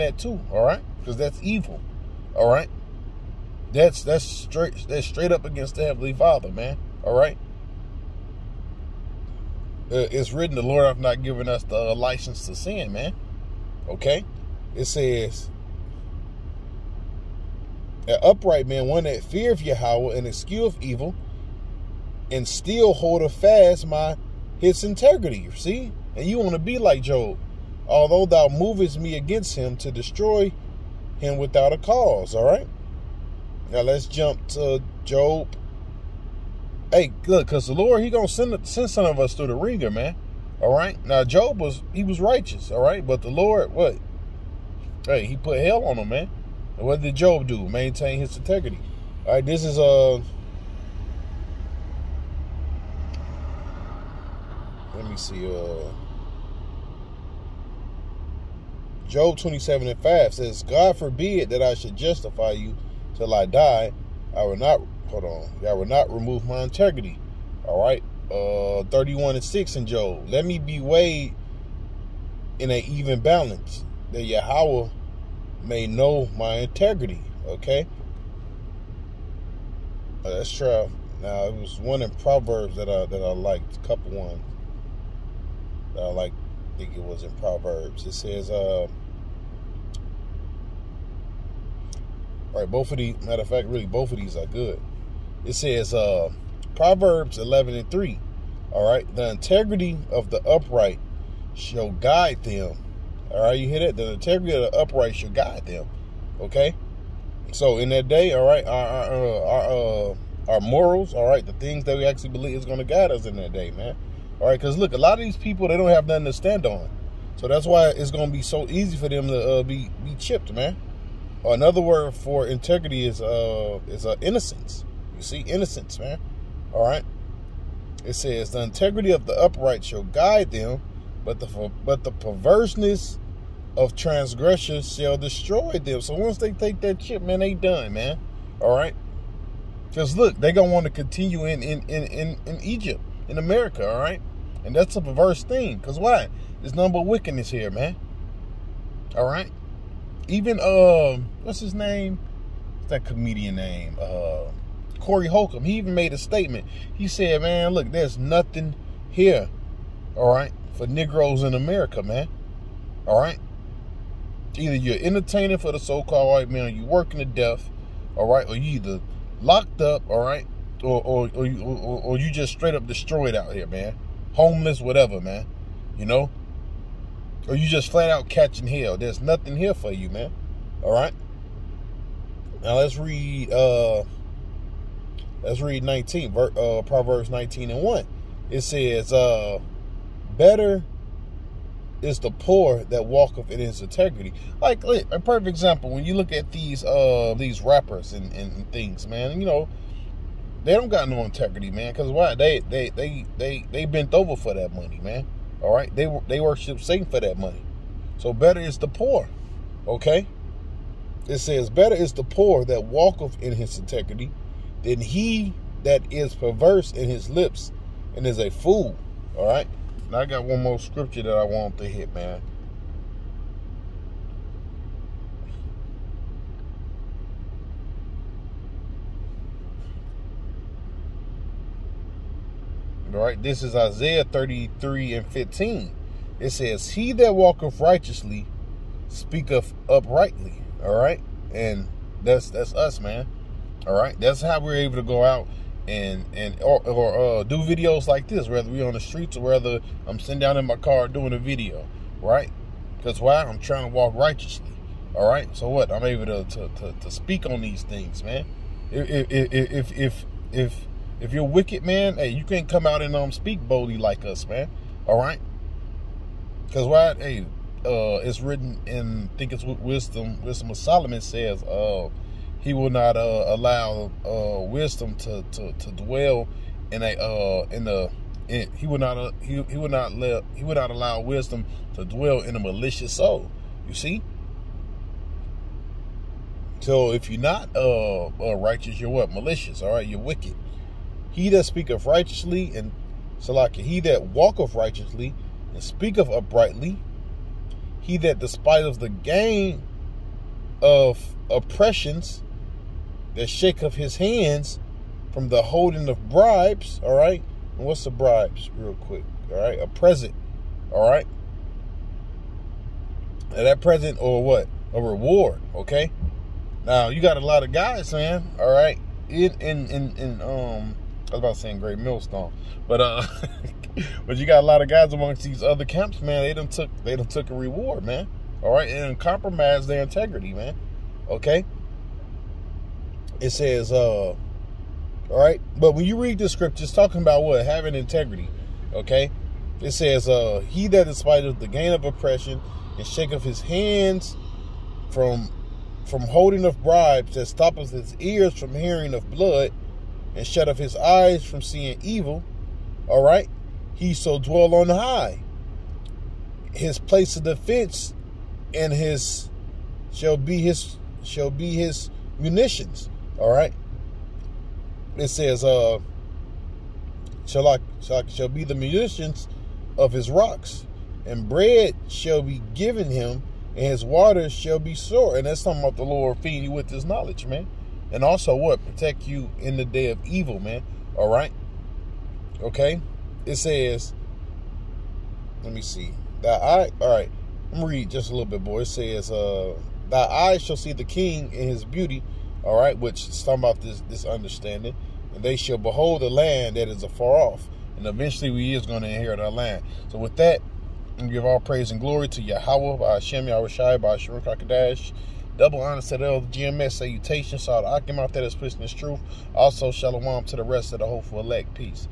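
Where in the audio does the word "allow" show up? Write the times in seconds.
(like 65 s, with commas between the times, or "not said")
273 s, 280 s.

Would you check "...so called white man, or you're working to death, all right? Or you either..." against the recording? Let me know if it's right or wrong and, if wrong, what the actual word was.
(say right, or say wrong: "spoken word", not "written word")
right.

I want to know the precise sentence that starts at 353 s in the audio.
All right, he so dwell on high.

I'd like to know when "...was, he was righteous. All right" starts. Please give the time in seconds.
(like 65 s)
41 s.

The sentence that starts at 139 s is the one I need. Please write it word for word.
Because look, they gonna want to continue in in, in in in Egypt, in America, all right?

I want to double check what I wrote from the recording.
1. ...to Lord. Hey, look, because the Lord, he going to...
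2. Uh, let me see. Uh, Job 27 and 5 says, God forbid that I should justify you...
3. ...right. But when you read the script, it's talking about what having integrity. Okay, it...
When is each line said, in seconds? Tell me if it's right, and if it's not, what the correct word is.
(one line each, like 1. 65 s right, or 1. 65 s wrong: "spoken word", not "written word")
1. 34 s wrong: "Job", not "Lord"
2. 49 s right
3. 335 s right.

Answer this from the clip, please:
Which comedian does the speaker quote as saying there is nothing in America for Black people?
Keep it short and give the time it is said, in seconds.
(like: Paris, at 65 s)
Corey Holcomb, at 154 s.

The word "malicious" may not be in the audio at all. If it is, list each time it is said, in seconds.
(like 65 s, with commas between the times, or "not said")
282 s, 289 s.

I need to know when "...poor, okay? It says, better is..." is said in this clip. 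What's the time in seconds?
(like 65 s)
208 s.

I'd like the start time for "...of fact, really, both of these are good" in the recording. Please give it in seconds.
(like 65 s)
93 s.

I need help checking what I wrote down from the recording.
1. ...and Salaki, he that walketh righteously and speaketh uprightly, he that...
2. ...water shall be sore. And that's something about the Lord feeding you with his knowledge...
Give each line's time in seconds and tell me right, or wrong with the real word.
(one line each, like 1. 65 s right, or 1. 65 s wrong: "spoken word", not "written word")
1. 292 s right
2. 374 s right.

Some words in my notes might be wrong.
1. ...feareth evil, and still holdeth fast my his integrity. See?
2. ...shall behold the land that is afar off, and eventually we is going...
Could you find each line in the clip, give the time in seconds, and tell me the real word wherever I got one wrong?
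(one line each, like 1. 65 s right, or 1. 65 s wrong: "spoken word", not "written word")
1. 20 s wrong: "escheweth", not "feareth"
2. 395 s right.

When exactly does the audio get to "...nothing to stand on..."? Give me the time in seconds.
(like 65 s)
116 s.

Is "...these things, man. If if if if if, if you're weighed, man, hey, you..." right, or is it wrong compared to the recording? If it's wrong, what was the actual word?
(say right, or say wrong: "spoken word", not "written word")
wrong: "wicked", not "weighed".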